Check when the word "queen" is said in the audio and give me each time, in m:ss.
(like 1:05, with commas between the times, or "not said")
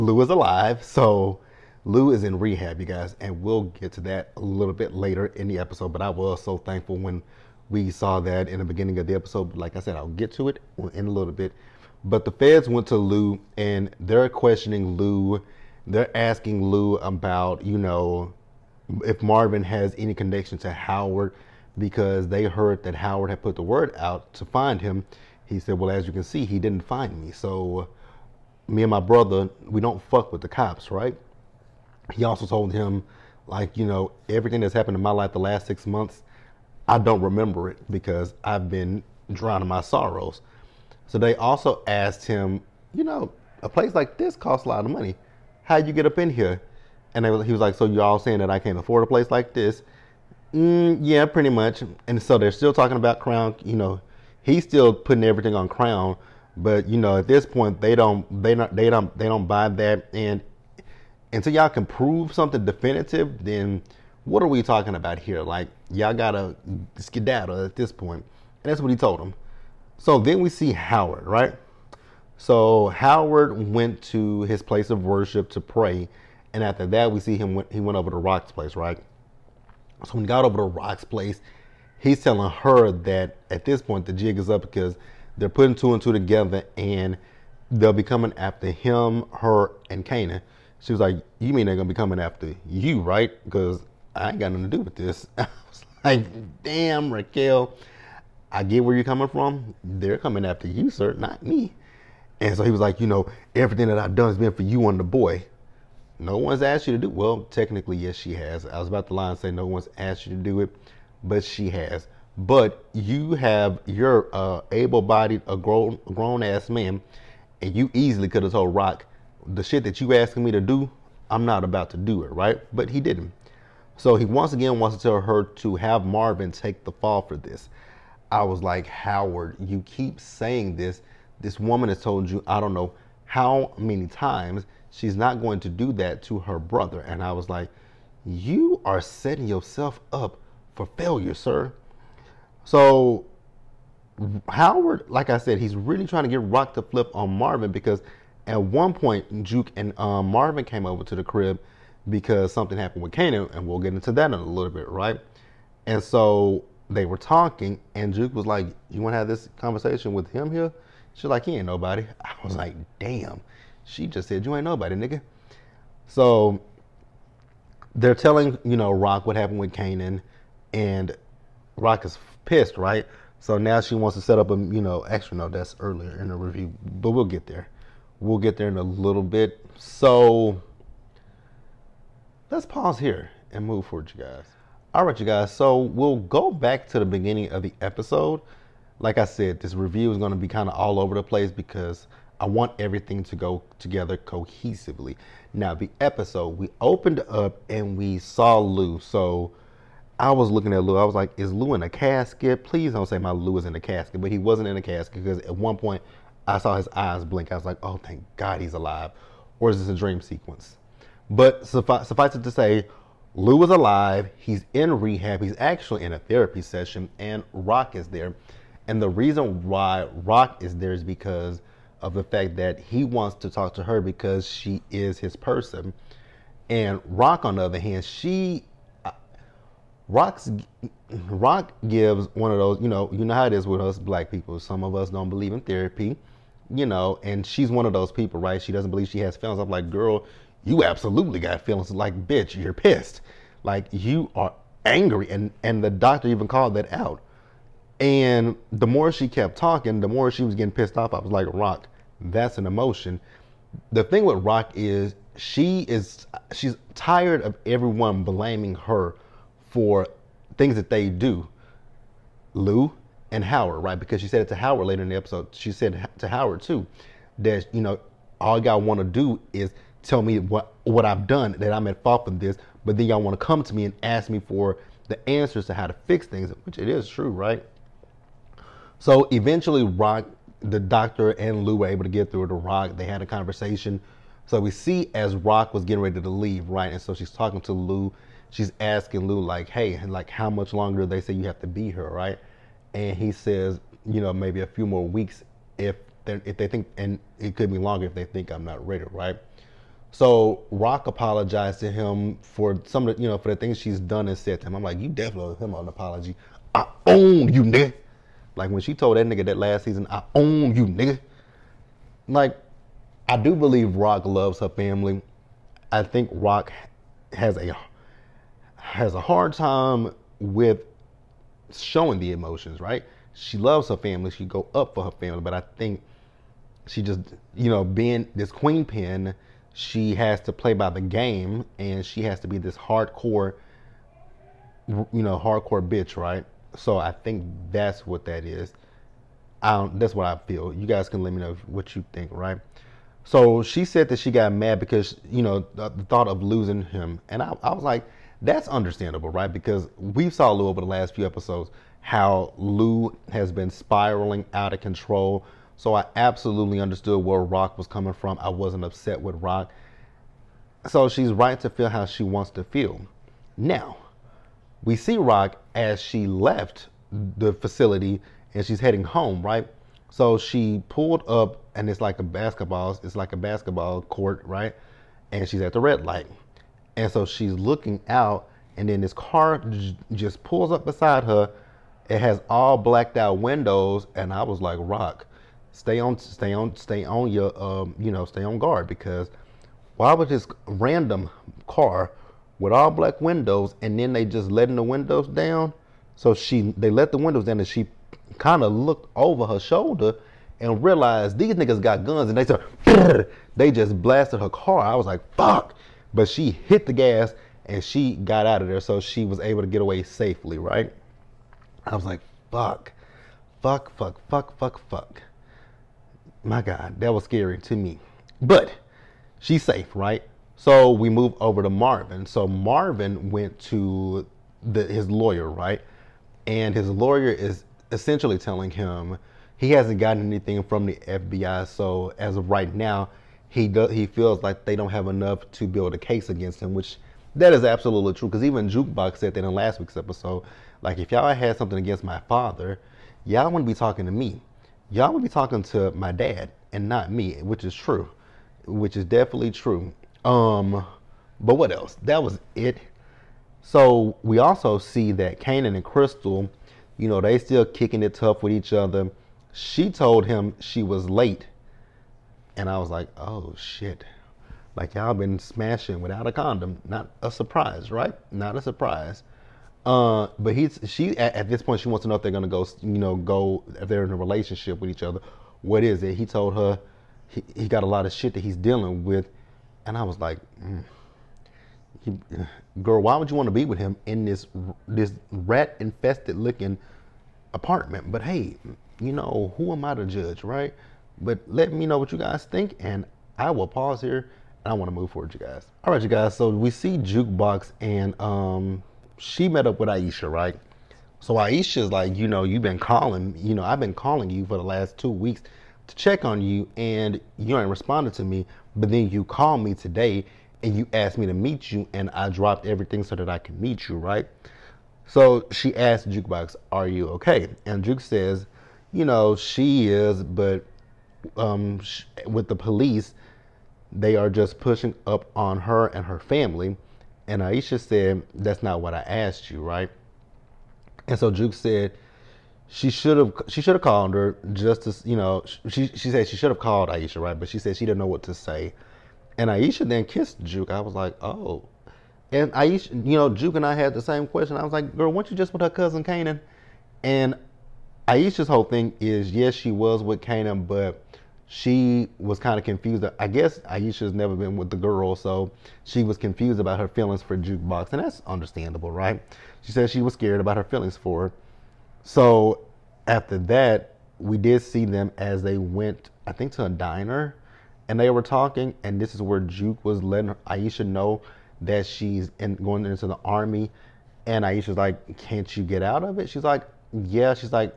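5:28.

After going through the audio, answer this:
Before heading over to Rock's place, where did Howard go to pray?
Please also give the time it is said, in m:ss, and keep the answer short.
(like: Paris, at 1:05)
his place of worship, at 1:14.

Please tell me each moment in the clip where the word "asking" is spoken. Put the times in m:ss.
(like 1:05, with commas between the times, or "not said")
0:16, 2:00, 4:48.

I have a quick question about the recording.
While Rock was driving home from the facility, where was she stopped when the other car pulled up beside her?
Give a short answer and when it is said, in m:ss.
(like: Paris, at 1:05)
at the red light, at 6:15.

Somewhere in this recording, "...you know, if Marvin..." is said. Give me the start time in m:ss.
0:17.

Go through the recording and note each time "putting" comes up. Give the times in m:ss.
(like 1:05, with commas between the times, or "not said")
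0:54, 1:25.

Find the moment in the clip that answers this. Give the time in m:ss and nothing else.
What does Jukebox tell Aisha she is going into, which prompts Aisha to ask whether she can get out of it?
9:33.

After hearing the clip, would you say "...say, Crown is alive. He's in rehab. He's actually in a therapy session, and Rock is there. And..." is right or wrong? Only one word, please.
wrong.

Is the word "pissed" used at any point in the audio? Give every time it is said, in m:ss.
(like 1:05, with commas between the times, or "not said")
2:52, 4:02, 4:10.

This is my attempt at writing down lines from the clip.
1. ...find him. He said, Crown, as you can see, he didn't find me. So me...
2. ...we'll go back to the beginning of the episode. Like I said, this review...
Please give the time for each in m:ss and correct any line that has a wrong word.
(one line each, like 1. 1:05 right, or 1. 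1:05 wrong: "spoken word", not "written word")
1. 0:24 wrong: "Well", not "Crown"
2. 3:05 right.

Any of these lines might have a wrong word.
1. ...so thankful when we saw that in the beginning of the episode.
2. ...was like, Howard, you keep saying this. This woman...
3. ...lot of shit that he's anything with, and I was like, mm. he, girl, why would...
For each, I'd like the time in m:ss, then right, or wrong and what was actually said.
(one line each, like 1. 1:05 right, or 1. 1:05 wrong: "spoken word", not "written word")
1. 0:06 right
2. 2:08 right
3. 7:57 wrong: "dealing", not "anything".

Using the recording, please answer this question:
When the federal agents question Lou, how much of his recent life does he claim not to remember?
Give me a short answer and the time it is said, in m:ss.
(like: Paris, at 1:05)
the last 6 months, at 0:35.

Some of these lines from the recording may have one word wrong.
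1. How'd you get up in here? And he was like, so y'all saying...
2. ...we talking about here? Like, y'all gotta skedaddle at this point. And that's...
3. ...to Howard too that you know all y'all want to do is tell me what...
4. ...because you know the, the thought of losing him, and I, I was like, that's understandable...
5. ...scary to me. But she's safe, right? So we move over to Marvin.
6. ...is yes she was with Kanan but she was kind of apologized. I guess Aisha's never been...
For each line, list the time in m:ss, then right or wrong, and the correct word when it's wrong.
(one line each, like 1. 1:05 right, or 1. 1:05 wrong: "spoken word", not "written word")
1. 0:45 right
2. 1:04 right
3. 4:26 right
4. 5:44 right
5. 6:57 right
6. 9:09 wrong: "confused", not "apologized".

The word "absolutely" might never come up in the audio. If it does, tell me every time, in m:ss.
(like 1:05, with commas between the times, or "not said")
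4:00, 5:56, 7:17.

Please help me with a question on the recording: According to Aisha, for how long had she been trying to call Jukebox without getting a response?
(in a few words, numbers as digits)
the last 2 weeks.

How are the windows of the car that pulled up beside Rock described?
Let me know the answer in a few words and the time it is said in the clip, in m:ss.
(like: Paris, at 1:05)
all blacked out, at 6:22.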